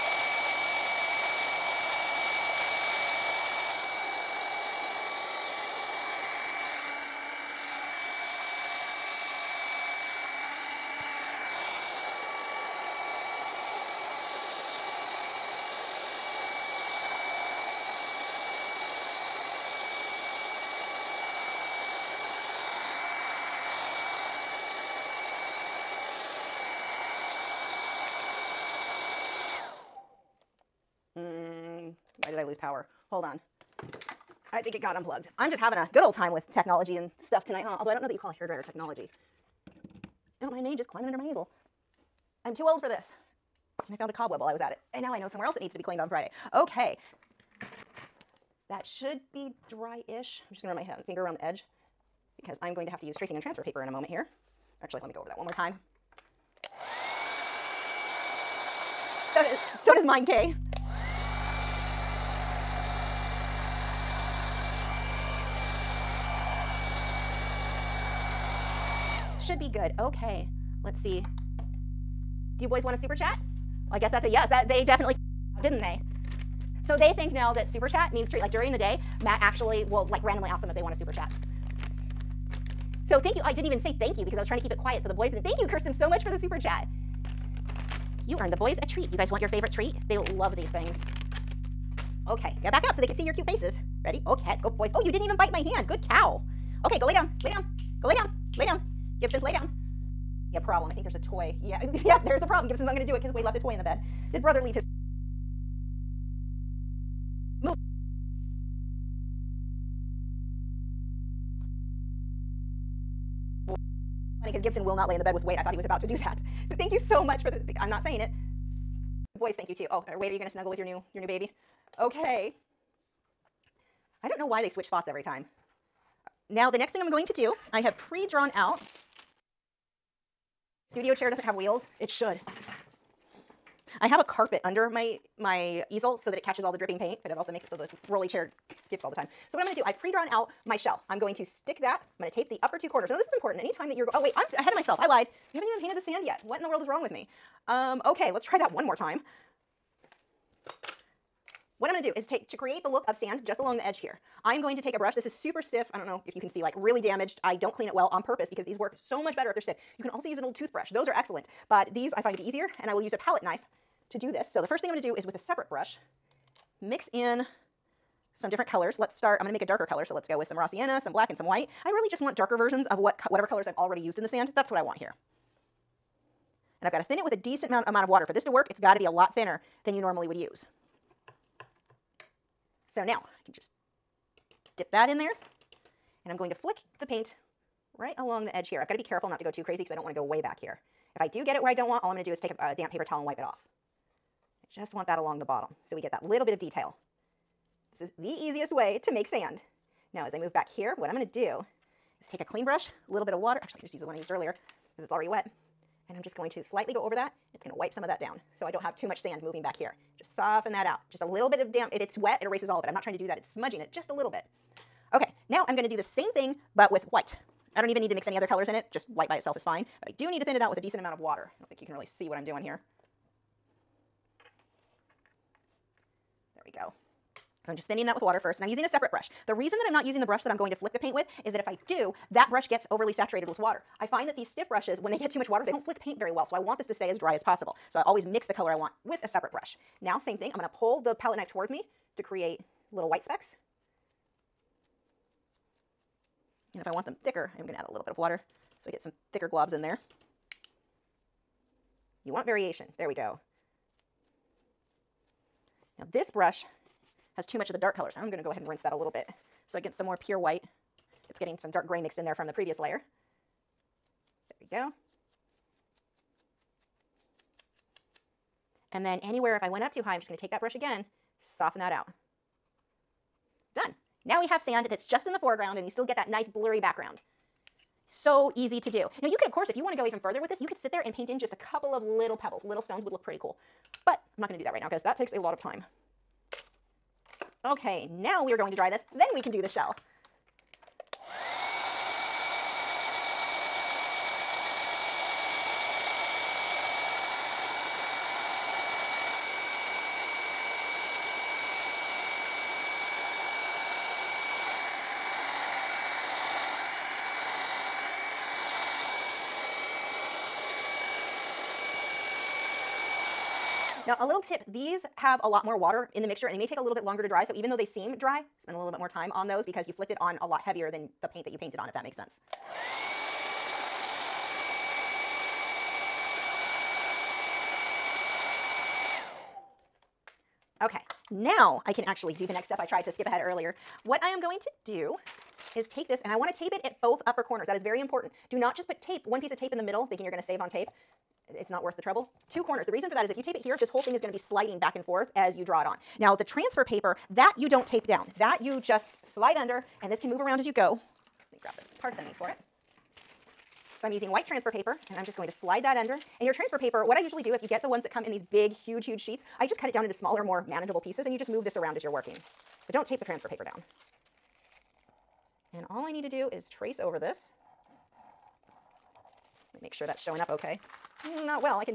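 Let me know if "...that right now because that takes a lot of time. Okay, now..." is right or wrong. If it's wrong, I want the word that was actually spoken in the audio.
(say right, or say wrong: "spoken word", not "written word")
right.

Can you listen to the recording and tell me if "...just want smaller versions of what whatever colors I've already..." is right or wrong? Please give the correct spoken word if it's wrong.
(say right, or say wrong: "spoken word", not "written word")
wrong: "darker", not "smaller".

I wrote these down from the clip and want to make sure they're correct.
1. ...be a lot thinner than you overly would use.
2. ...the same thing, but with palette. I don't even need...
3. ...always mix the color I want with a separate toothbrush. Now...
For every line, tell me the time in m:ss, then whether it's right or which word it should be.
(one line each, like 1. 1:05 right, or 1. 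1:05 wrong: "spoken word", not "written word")
1. 2:58 wrong: "normally", not "overly"
2. 3:35 wrong: "white", not "palette"
3. 3:58 wrong: "brush", not "toothbrush".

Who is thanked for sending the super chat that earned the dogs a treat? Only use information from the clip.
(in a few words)
Kirsten.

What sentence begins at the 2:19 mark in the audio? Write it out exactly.
So what I'm gonna do, I've pre-drawn out my shell.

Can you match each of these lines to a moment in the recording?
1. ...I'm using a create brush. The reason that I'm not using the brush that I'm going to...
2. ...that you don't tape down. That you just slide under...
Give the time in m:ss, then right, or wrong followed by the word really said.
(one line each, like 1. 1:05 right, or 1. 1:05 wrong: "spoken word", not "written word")
1. 3:48 wrong: "separate", not "create"
2. 5:47 right.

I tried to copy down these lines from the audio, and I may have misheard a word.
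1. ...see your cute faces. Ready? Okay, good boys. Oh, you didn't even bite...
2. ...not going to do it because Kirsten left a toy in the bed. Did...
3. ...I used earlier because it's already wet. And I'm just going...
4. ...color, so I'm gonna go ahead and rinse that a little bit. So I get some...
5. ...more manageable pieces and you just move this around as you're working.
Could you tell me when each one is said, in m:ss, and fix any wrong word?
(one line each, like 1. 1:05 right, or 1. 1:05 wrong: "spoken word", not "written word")
1. 1:33 right
2. 1:42 wrong: "Wade", not "Kirsten"
3. 3:24 right
4. 4:17 right
5. 6:00 right.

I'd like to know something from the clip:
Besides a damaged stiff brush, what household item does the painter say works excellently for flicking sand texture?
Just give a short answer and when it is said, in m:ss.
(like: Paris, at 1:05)
An old toothbrush, at 2:40.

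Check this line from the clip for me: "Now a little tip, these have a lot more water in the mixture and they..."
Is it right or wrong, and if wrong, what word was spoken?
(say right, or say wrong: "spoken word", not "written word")
right.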